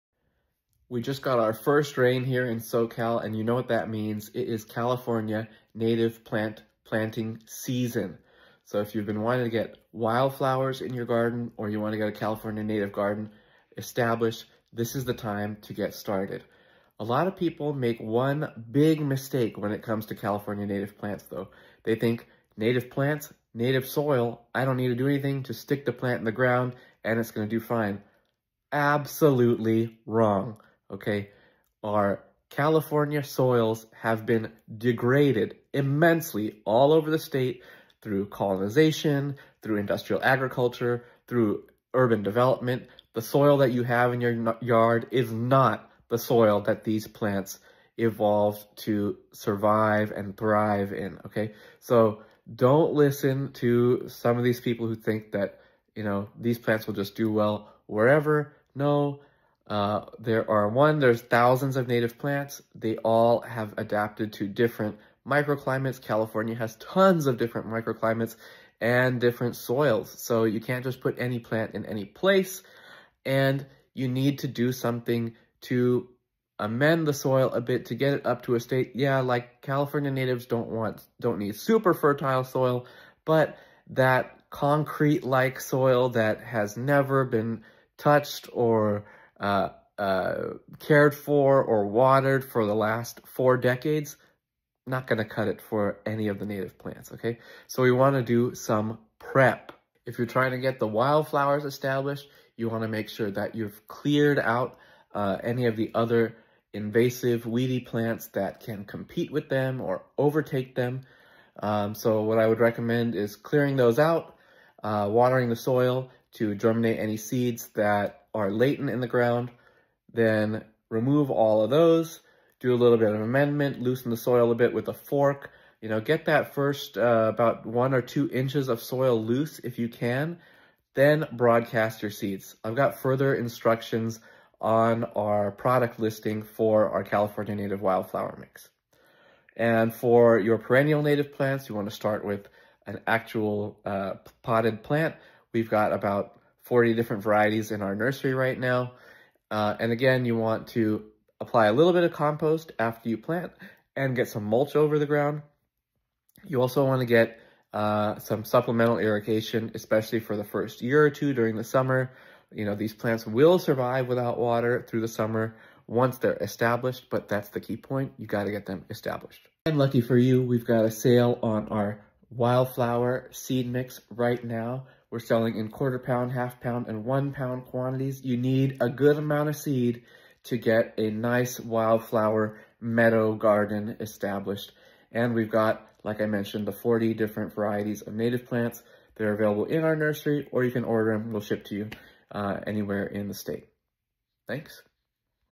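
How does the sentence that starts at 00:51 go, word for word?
So don't listen to some of these people who think that, you know, these plants will just do well wherever.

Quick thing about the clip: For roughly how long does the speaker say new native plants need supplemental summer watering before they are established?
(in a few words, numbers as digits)
first year or two.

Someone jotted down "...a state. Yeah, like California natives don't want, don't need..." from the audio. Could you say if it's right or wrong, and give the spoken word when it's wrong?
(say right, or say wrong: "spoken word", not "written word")
right.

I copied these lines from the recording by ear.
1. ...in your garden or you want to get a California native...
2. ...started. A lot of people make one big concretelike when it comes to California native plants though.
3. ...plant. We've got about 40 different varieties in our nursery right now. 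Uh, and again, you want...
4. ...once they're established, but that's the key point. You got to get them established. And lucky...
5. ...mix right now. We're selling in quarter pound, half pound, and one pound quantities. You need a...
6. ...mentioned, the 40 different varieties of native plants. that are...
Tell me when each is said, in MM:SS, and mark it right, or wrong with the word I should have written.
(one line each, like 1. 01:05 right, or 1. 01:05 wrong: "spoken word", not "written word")
1. 00:10 right
2. 00:15 wrong: "mistake", not "concretelike"
3. 02:24 right
4. 02:45 right
5. 02:53 right
6. 03:06 right.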